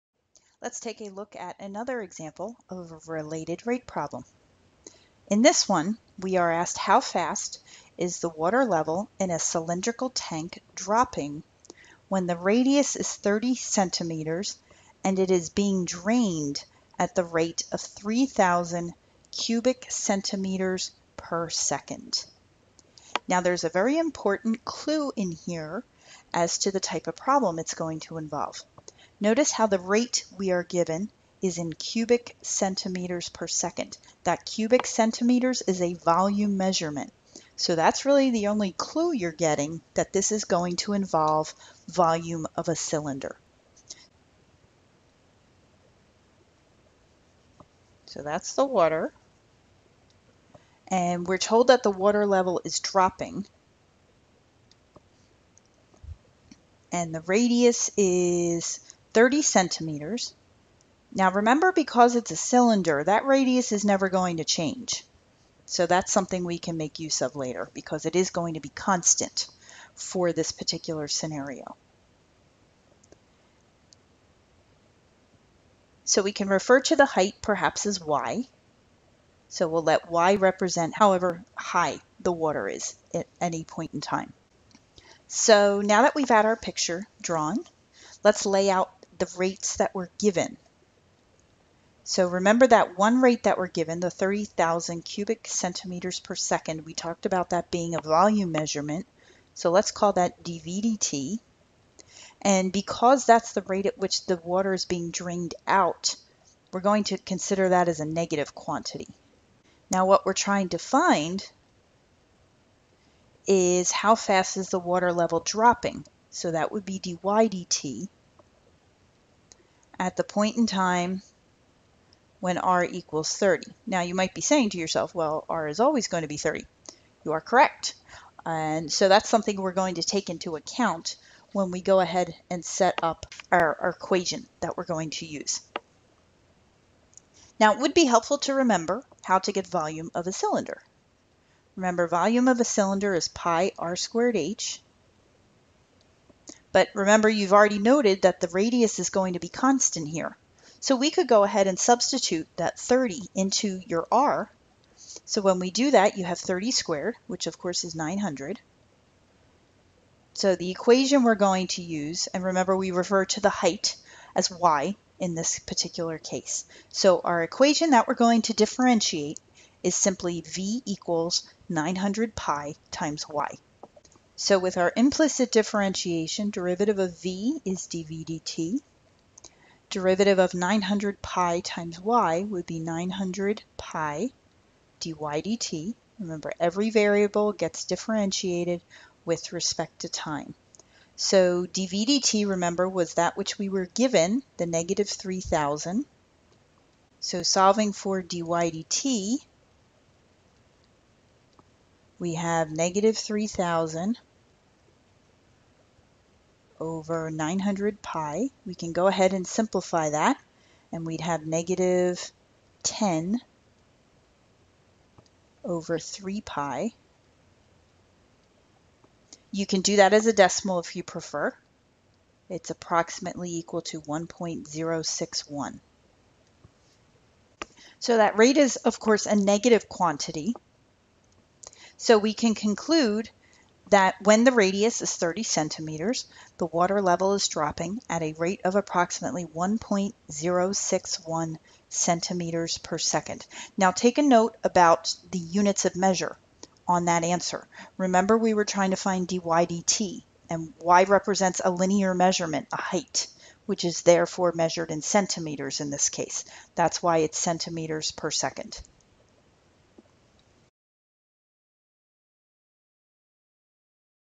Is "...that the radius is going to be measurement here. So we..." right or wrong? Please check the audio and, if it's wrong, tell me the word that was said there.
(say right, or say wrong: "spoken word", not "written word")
wrong: "constant", not "measurement".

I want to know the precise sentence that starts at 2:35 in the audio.
So when we do that, you have 30 squared, which of course is 900.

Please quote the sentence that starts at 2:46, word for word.
So our equation that we're going to differentiate is simply v equals 900 pi times y.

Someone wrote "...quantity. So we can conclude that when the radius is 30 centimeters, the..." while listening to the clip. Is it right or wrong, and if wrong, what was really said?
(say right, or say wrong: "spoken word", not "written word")
right.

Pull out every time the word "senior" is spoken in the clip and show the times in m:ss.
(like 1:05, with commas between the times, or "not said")
not said.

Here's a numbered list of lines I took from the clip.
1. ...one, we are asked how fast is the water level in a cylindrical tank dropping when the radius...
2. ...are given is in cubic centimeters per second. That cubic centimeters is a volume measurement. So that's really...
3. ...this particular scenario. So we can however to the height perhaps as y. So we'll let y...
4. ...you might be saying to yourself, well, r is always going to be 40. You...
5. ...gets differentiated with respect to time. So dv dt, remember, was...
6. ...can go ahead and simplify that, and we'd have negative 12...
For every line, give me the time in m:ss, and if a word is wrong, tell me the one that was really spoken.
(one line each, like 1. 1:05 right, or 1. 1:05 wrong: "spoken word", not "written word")
1. 0:05 right
2. 0:30 right
3. 1:10 wrong: "refer", not "however"
4. 2:04 wrong: "30", not "40"
5. 3:07 right
6. 3:28 wrong: "10", not "12".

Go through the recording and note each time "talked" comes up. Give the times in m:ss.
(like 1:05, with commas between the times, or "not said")
1:36.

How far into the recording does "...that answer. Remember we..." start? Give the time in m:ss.
4:07.